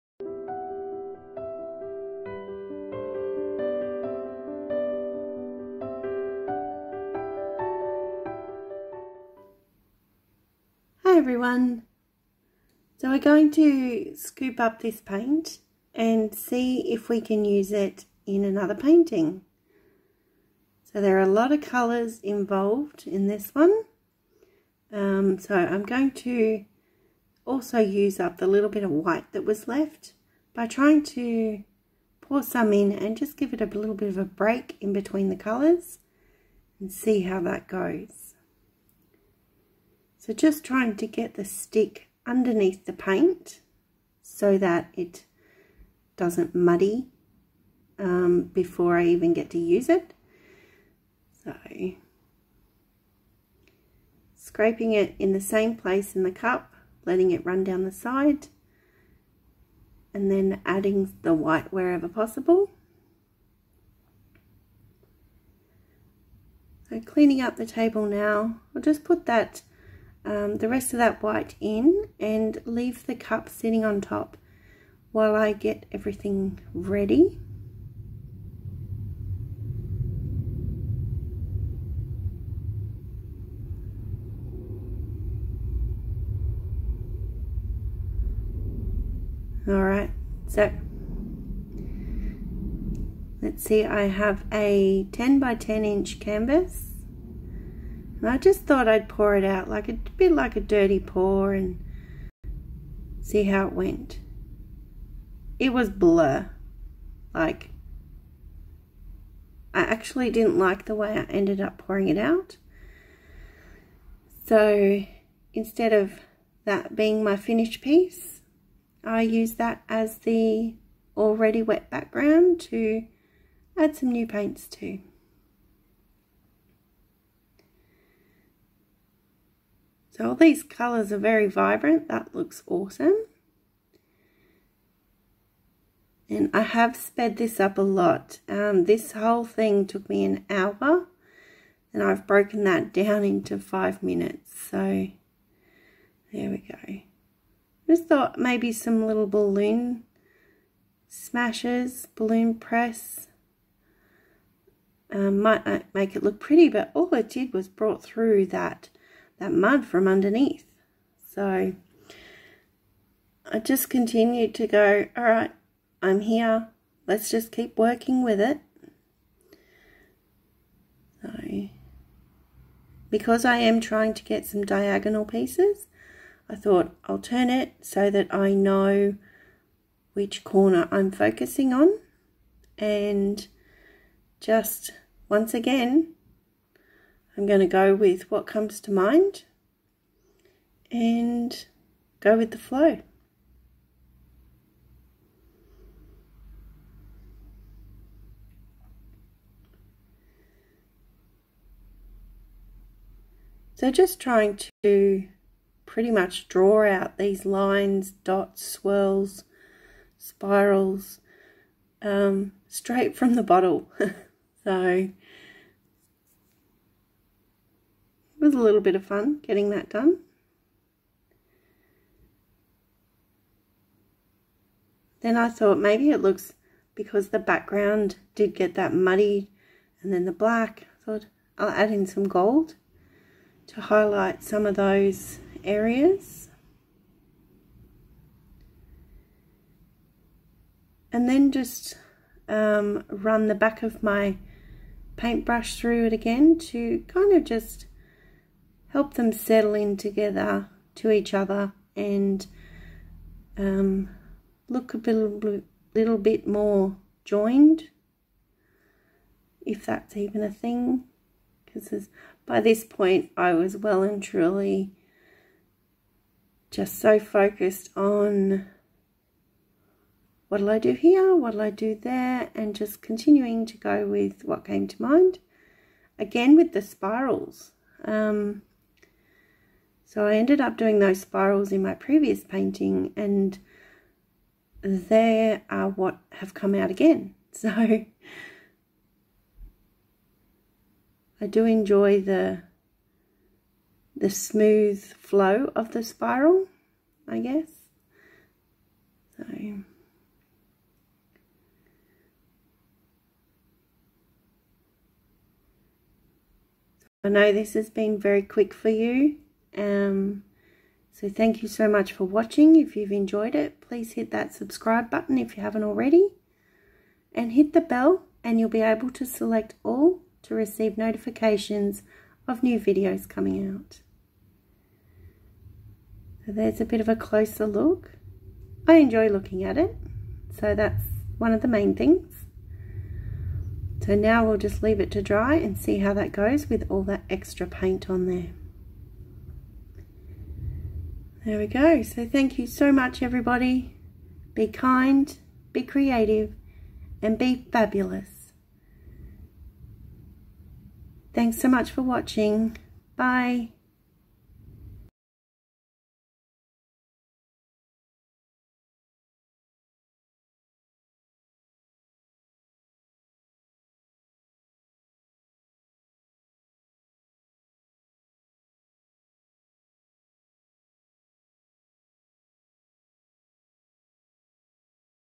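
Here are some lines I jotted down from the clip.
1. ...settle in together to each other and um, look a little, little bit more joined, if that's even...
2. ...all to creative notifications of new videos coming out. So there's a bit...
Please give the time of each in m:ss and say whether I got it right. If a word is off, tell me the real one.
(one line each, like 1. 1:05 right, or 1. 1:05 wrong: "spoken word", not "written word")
1. 4:09 right
2. 5:19 wrong: "receive", not "creative".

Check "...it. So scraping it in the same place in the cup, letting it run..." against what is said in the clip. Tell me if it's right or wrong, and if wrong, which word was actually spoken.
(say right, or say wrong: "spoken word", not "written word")
right.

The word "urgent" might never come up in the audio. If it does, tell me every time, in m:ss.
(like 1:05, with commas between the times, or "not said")
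not said.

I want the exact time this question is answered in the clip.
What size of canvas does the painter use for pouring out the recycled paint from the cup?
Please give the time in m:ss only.
1:35.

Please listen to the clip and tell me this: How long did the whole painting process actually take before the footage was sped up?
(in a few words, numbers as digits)
an hour.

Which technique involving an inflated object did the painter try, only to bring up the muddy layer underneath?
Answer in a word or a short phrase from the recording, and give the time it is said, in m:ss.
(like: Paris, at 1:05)
balloon press, at 2:32.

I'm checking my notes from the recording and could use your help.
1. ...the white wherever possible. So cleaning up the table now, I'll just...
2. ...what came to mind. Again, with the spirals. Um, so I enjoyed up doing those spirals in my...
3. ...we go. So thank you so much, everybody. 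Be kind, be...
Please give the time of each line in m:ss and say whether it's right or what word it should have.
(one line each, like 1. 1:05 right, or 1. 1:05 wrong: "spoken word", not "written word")
1. 1:01 right
2. 4:34 wrong: "ended", not "enjoyed"
3. 5:41 right.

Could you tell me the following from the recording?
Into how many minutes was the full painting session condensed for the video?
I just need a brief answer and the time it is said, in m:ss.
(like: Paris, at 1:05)
5 minutes, at 2:23.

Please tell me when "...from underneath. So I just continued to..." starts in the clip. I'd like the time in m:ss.
2:39.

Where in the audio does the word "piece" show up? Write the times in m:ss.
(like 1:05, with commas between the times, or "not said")
1:57, 2:55.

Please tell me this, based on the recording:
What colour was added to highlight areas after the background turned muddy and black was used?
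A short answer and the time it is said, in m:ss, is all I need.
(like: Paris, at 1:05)
gold, at 3:52.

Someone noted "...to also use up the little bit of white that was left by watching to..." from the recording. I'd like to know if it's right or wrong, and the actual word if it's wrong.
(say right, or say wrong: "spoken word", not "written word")
wrong: "trying", not "watching".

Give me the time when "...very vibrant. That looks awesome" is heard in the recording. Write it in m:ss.
2:11.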